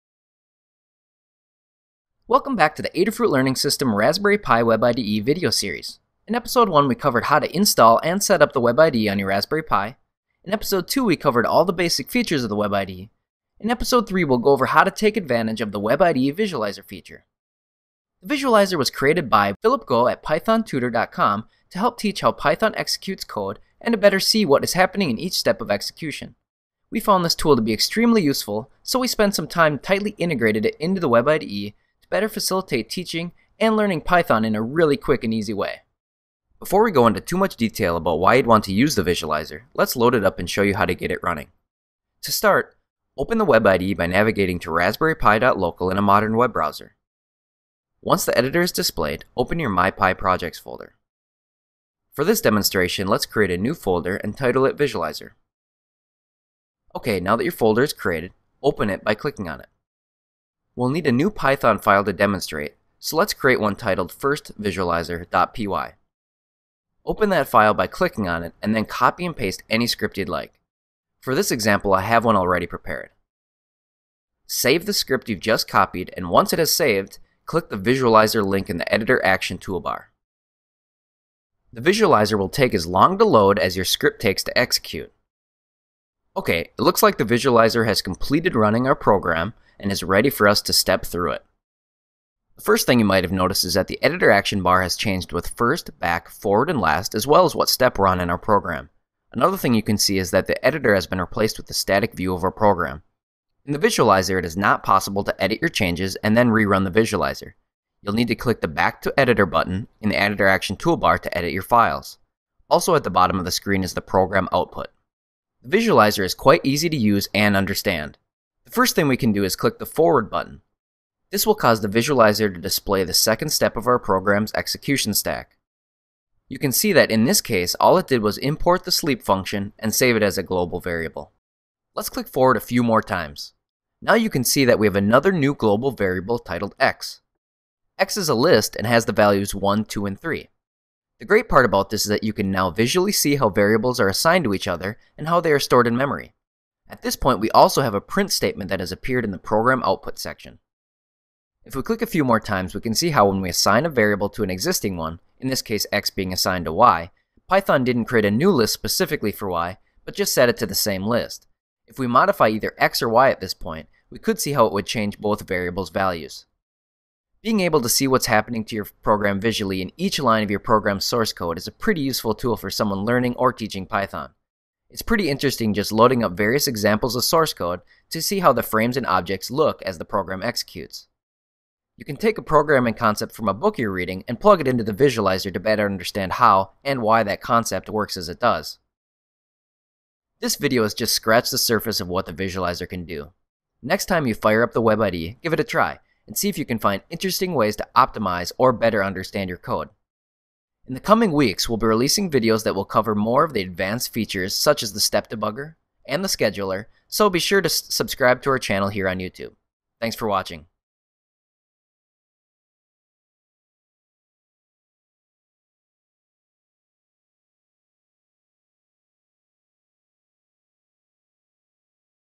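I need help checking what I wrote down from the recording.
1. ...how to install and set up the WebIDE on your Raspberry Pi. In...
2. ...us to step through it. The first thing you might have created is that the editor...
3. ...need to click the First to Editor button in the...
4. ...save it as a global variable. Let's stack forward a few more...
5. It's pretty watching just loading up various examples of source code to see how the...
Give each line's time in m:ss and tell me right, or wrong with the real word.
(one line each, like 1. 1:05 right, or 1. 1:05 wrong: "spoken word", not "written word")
1. 0:07 right
2. 1:30 wrong: "noticed", not "created"
3. 1:48 wrong: "Back", not "First"
4. 2:09 wrong: "click", not "stack"
5. 2:54 wrong: "interesting", not "watching".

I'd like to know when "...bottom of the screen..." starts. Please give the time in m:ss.
1:53.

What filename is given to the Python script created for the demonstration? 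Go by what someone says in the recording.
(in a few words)
firstvisualizer.py.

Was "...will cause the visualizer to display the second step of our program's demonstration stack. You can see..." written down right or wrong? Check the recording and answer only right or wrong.
wrong.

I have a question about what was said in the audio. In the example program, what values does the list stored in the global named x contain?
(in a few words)
1, 2, and 3.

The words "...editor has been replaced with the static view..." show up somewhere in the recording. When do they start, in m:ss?
1:40.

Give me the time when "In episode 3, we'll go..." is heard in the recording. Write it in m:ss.
0:13.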